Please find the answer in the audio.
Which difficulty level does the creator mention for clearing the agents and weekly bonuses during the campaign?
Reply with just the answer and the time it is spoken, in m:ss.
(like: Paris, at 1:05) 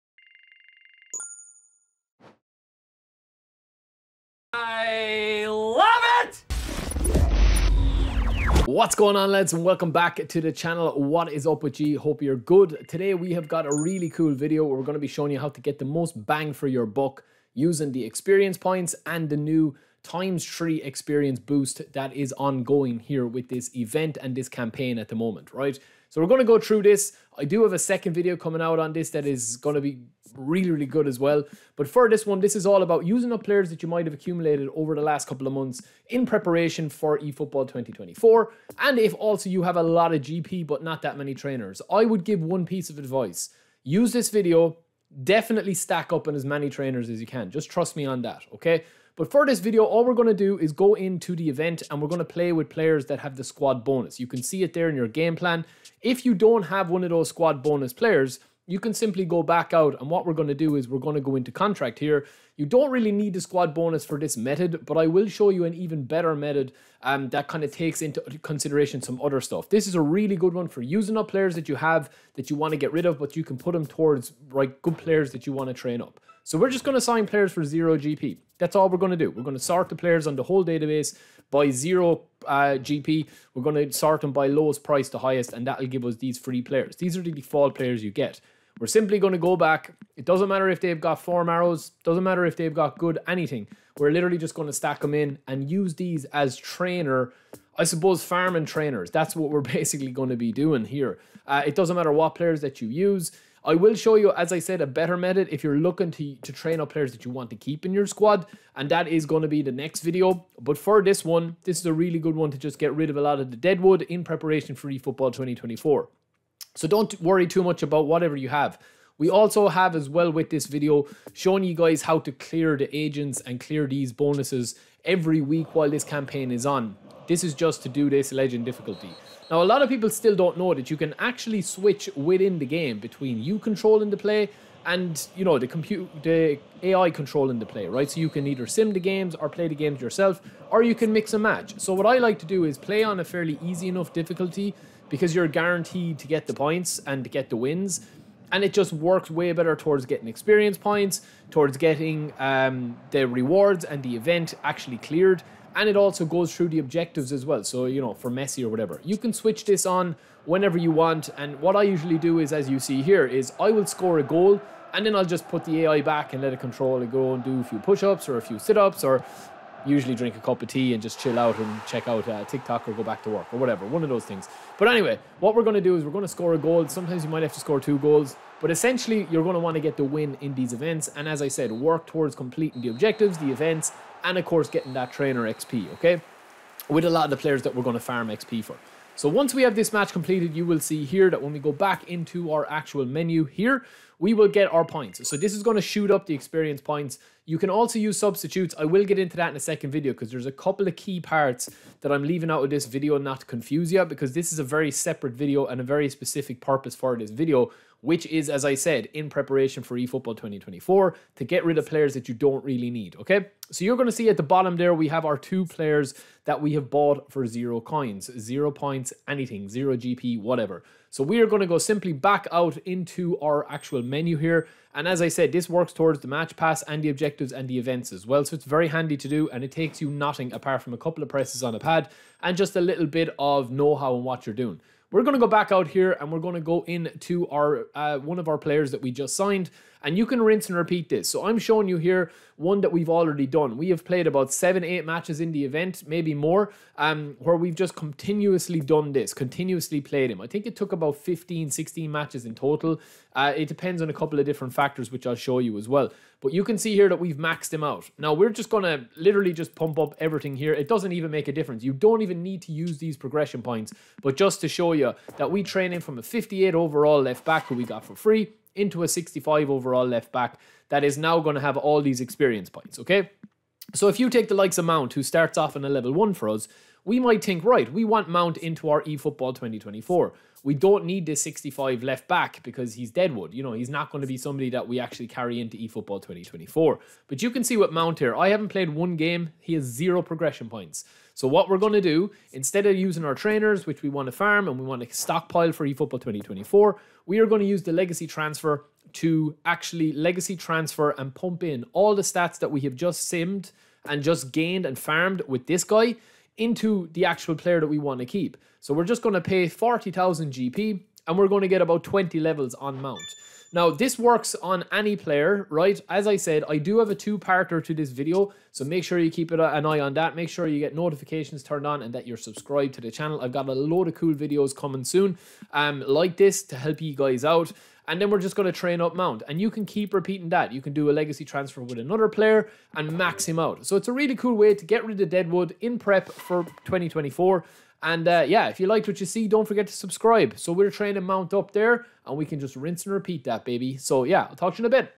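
legend, at 2:08.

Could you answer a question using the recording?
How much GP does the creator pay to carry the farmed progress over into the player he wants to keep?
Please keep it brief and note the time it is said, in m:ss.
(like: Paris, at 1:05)
40,000 GP, at 5:09.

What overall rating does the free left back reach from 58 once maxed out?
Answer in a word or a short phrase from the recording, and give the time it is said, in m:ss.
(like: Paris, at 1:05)
65, at 4:29.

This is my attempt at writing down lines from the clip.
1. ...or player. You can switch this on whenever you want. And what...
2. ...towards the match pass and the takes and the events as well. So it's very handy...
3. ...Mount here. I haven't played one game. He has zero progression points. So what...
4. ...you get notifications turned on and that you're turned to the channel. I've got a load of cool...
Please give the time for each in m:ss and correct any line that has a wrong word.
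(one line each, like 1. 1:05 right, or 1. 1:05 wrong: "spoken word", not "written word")
1. 2:38 wrong: "whatever", not "player"
2. 3:45 wrong: "objectives", not "takes"
3. 4:47 right
4. 5:20 wrong: "subscribed", not "turned".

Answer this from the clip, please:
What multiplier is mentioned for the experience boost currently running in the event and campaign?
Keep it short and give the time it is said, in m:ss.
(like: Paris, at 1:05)
times three, at 0:20.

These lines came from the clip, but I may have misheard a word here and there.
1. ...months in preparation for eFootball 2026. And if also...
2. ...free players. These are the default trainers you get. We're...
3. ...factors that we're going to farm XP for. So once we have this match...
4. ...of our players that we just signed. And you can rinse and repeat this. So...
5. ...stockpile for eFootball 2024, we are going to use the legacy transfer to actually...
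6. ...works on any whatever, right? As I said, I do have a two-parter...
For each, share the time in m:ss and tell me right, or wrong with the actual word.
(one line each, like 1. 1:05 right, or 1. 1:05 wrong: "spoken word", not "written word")
1. 0:35 wrong: "2024", not "2026"
2. 1:26 wrong: "players", not "trainers"
3. 3:07 wrong: "players", not "factors"
4. 3:58 right
5. 4:55 right
6. 5:14 wrong: "player", not "whatever".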